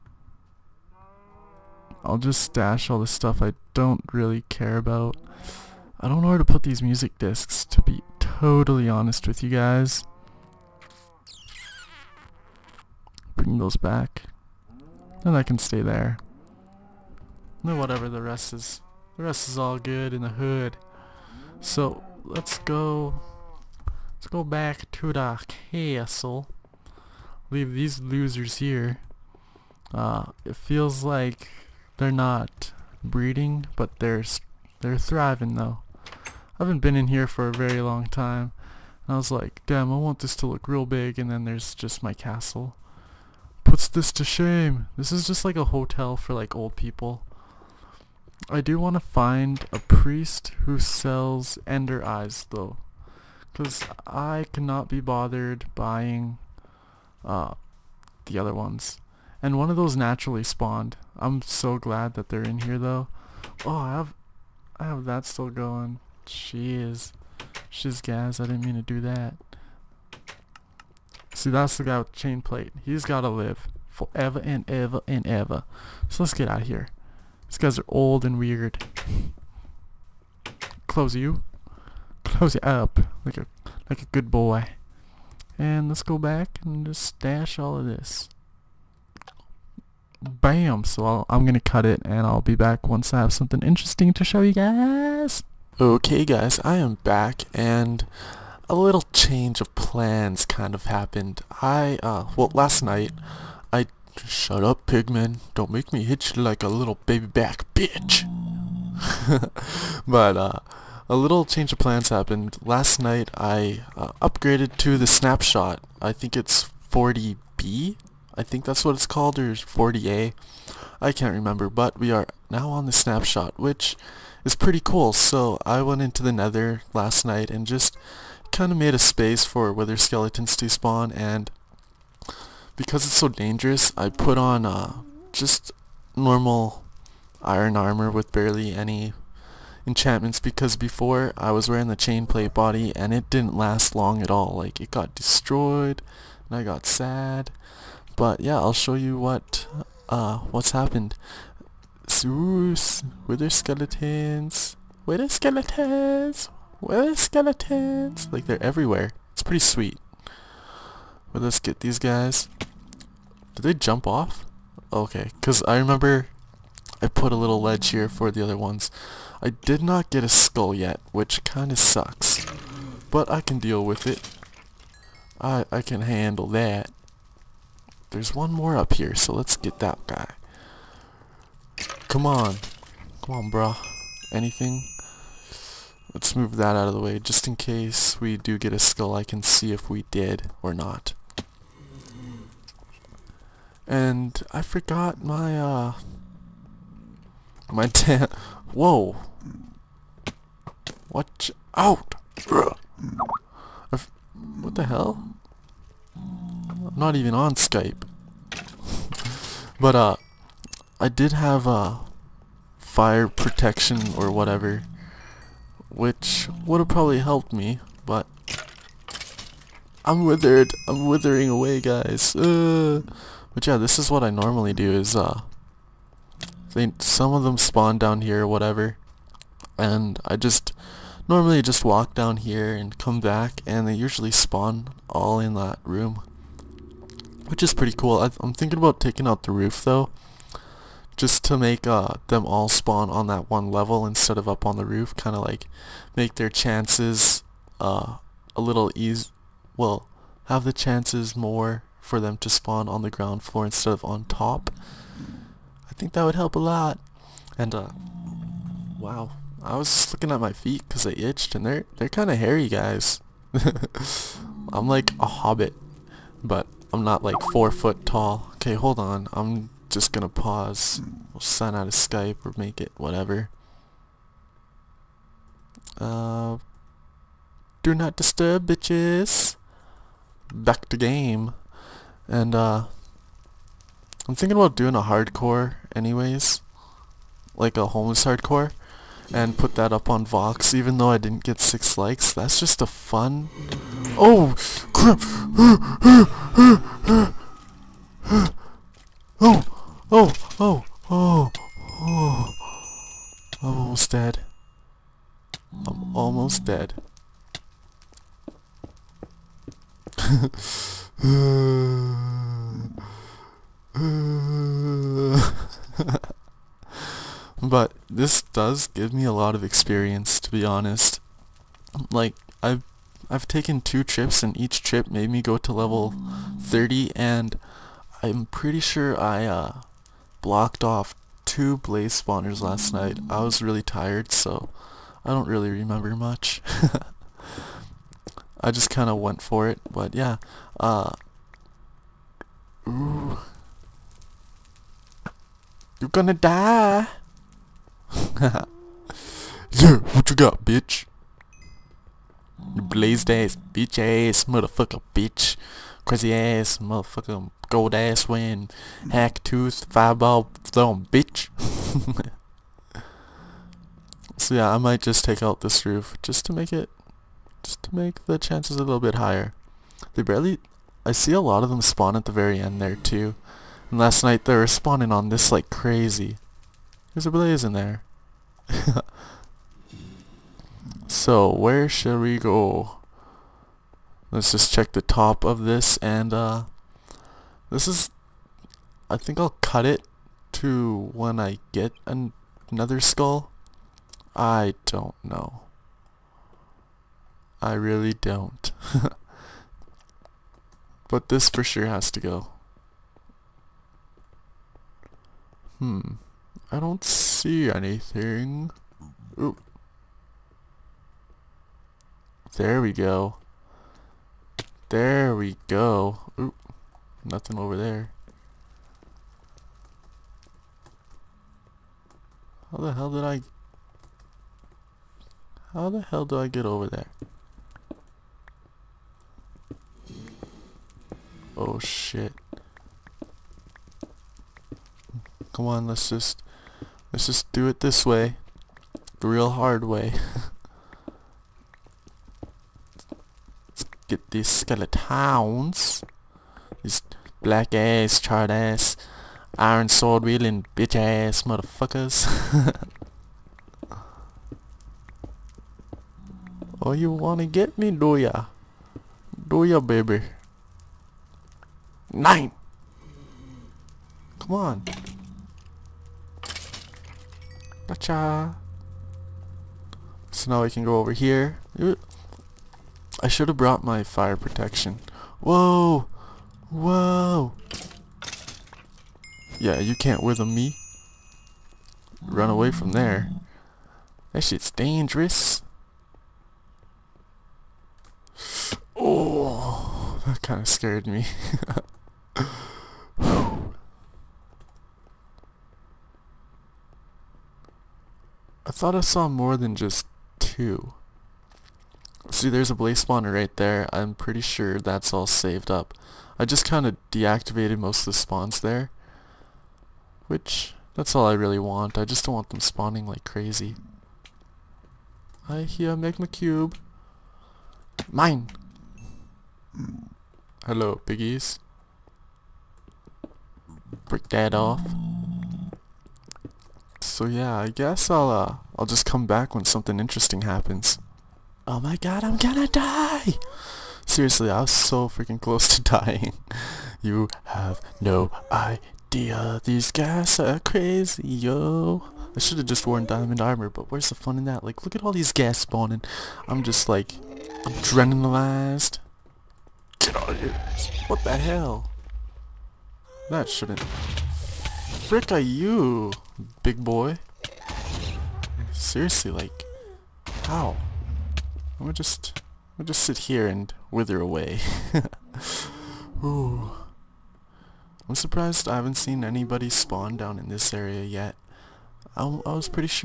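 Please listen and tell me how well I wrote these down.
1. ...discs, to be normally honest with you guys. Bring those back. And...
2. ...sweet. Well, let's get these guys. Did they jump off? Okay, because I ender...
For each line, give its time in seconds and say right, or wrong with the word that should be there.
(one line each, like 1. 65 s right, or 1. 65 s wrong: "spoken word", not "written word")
1. 7 s wrong: "totally", not "normally"
2. 159 s wrong: "remember", not "ender".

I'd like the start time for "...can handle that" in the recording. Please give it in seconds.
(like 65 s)
175 s.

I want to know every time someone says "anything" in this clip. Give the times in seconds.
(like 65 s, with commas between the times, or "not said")
184 s, 407 s.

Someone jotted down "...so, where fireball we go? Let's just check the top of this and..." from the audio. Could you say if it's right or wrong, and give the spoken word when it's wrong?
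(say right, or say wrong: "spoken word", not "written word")
wrong: "shall", not "fireball".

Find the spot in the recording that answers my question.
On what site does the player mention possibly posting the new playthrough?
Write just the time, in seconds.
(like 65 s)
290 s.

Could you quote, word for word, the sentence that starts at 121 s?
I can't remember, but we are now on the snapshot, which is pretty cool.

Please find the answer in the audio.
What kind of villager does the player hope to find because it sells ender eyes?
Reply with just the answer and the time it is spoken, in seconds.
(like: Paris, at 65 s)
priest, at 49 s.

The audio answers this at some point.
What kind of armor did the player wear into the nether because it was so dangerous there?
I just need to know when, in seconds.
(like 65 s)
137 s.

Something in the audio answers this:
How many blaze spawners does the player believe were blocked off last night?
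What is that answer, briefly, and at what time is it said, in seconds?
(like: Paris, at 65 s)
2, at 331 s.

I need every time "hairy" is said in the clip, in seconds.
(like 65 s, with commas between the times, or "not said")
262 s.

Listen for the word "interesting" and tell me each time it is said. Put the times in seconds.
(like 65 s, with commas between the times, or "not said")
93 s, 529 s.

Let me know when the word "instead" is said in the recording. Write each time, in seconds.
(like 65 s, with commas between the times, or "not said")
244 s, 253 s.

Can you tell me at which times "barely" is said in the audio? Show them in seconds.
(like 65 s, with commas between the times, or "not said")
138 s, 370 s.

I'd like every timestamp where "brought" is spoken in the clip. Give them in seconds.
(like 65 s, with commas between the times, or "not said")
473 s.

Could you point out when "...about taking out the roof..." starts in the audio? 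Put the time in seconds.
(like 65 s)
238 s.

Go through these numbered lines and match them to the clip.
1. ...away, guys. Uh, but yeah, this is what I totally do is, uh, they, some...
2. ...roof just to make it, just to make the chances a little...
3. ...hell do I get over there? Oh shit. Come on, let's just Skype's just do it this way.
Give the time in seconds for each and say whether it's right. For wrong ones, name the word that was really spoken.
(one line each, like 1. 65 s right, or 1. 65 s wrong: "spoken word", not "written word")
1. 221 s wrong: "normally", not "totally"
2. 365 s right
3. 426 s wrong: "Let", not "Skype".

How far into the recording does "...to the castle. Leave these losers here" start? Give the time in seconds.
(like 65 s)
24 s.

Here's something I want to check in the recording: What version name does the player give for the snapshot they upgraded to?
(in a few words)
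40B.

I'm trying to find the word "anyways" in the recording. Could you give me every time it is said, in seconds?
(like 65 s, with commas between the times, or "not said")
285 s.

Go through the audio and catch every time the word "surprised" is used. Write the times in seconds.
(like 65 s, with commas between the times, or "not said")
568 s.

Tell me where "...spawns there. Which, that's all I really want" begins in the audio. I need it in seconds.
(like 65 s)
508 s.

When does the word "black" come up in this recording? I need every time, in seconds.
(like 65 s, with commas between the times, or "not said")
447 s.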